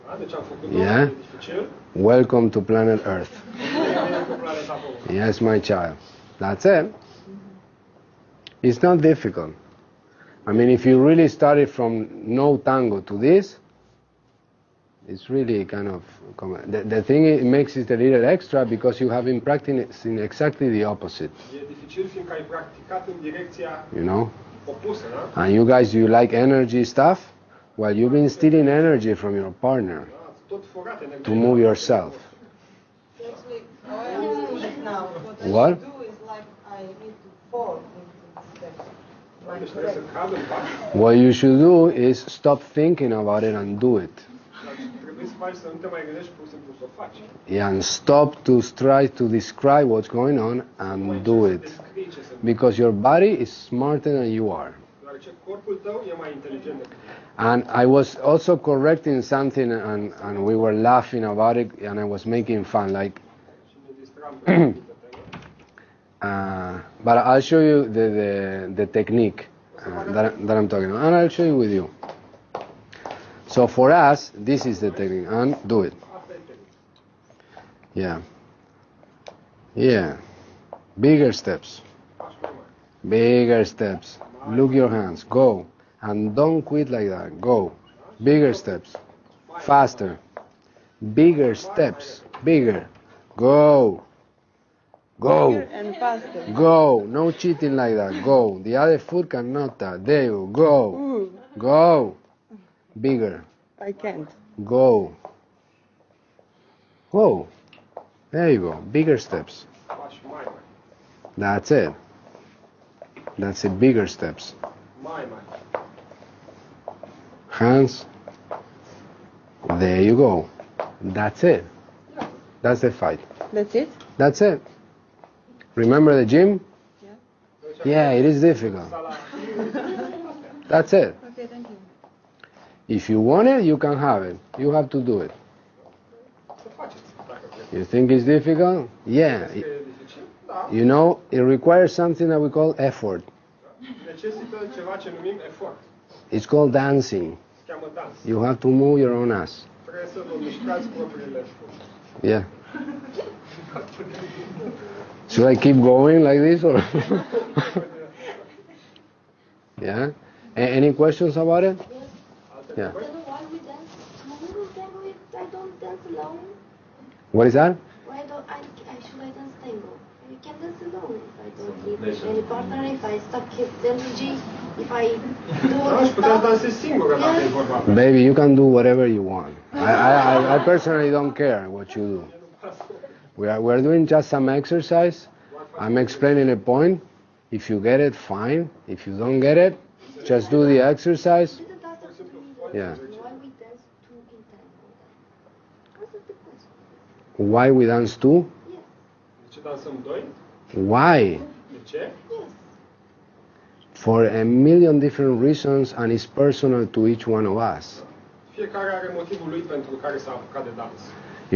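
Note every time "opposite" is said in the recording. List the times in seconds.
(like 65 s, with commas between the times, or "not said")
20 s.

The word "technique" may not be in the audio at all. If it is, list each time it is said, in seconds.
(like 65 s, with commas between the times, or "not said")
68 s, 74 s.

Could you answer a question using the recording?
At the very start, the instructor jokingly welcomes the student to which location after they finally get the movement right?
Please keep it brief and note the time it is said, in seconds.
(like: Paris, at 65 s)
planet Earth, at 2 s.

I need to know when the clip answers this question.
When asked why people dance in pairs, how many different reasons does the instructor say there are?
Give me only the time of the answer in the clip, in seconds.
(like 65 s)
204 s.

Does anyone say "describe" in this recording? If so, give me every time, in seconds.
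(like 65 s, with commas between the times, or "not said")
49 s.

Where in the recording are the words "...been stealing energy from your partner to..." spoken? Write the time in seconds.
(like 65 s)
28 s.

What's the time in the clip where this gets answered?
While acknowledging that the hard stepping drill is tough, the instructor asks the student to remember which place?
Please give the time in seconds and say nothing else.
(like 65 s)
126 s.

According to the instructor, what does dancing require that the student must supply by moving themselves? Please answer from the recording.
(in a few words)
effort.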